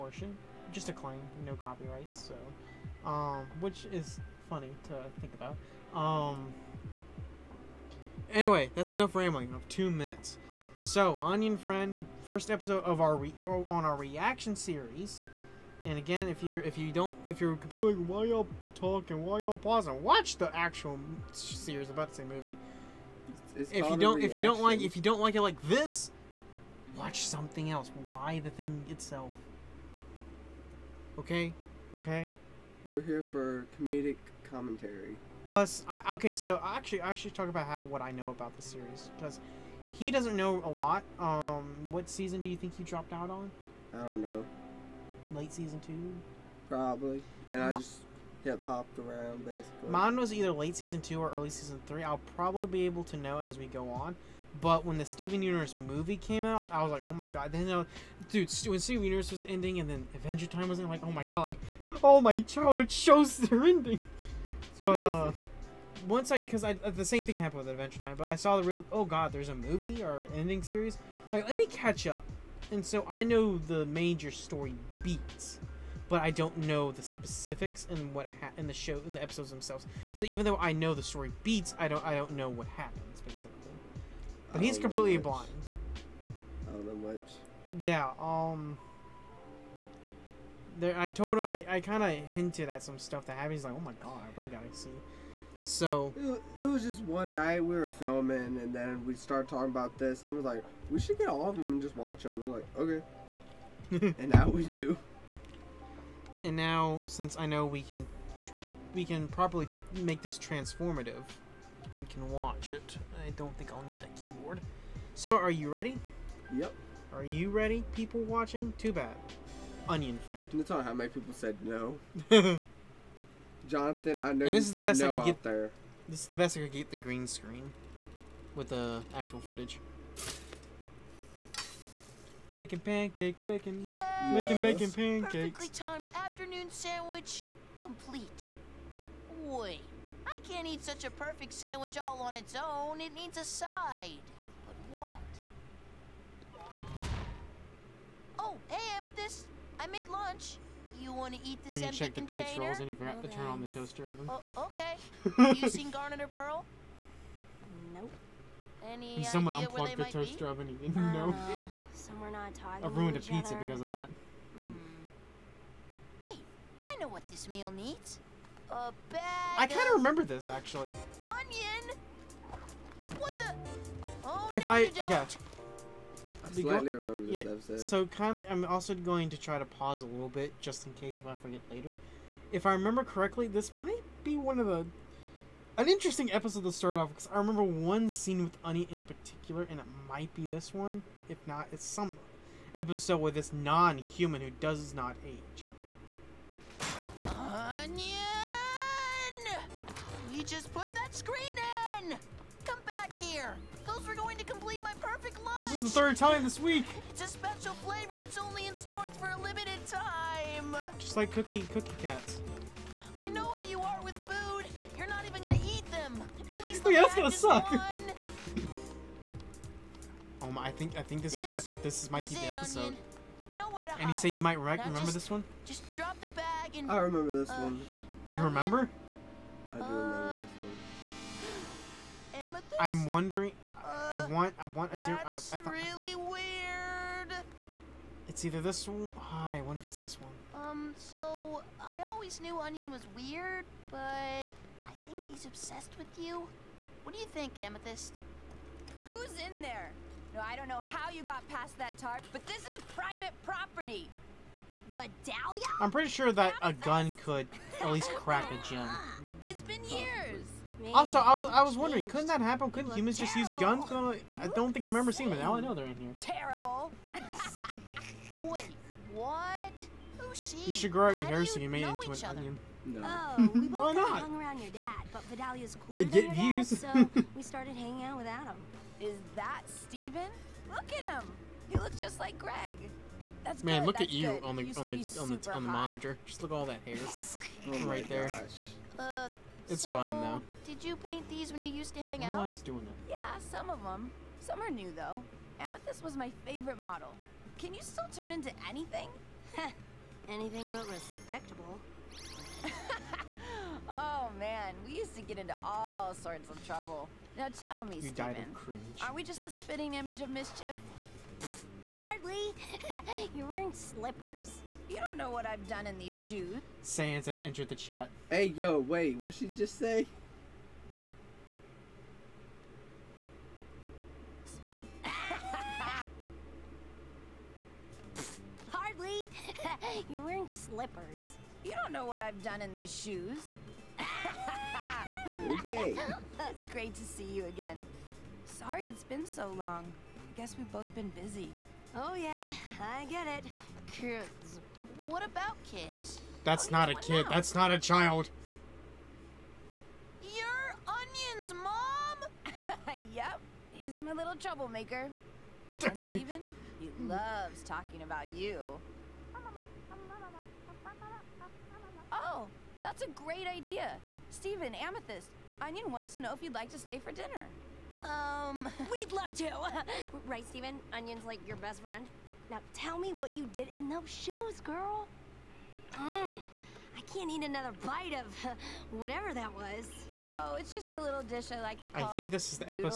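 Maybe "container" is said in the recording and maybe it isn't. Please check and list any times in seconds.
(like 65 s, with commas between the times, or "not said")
152 s.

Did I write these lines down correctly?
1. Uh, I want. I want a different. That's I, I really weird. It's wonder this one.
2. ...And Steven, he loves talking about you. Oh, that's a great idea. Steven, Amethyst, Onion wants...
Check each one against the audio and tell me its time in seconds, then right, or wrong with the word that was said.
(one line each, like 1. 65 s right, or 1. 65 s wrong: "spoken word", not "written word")
1. 233 s wrong: "either", not "wonder"
2. 355 s right.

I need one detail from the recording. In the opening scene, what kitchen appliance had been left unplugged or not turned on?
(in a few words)
Toaster oven.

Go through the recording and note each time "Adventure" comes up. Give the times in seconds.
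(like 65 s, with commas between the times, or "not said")
60 s, 67 s.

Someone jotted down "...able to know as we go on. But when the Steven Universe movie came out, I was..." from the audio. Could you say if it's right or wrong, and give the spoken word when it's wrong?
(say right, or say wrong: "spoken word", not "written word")
right.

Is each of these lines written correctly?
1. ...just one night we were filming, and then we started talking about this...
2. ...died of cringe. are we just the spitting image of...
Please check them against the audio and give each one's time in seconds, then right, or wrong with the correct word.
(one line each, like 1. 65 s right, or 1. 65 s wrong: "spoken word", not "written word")
1. 96 s right
2. 308 s right.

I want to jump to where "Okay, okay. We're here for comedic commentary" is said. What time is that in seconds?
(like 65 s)
31 s.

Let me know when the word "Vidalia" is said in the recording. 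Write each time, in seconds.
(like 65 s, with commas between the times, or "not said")
254 s, 275 s.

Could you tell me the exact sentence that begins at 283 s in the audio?
That's Man, good, look that's at you good.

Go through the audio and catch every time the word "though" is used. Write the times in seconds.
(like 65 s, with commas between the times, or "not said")
80 s, 290 s, 294 s.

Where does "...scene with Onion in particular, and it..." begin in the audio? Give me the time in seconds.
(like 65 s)
188 s.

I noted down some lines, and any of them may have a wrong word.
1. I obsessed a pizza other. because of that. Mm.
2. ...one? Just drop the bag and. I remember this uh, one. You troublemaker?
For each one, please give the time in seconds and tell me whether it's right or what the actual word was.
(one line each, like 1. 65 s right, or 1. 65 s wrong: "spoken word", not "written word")
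1. 162 s wrong: "ruined", not "obsessed"
2. 225 s wrong: "remember", not "troublemaker".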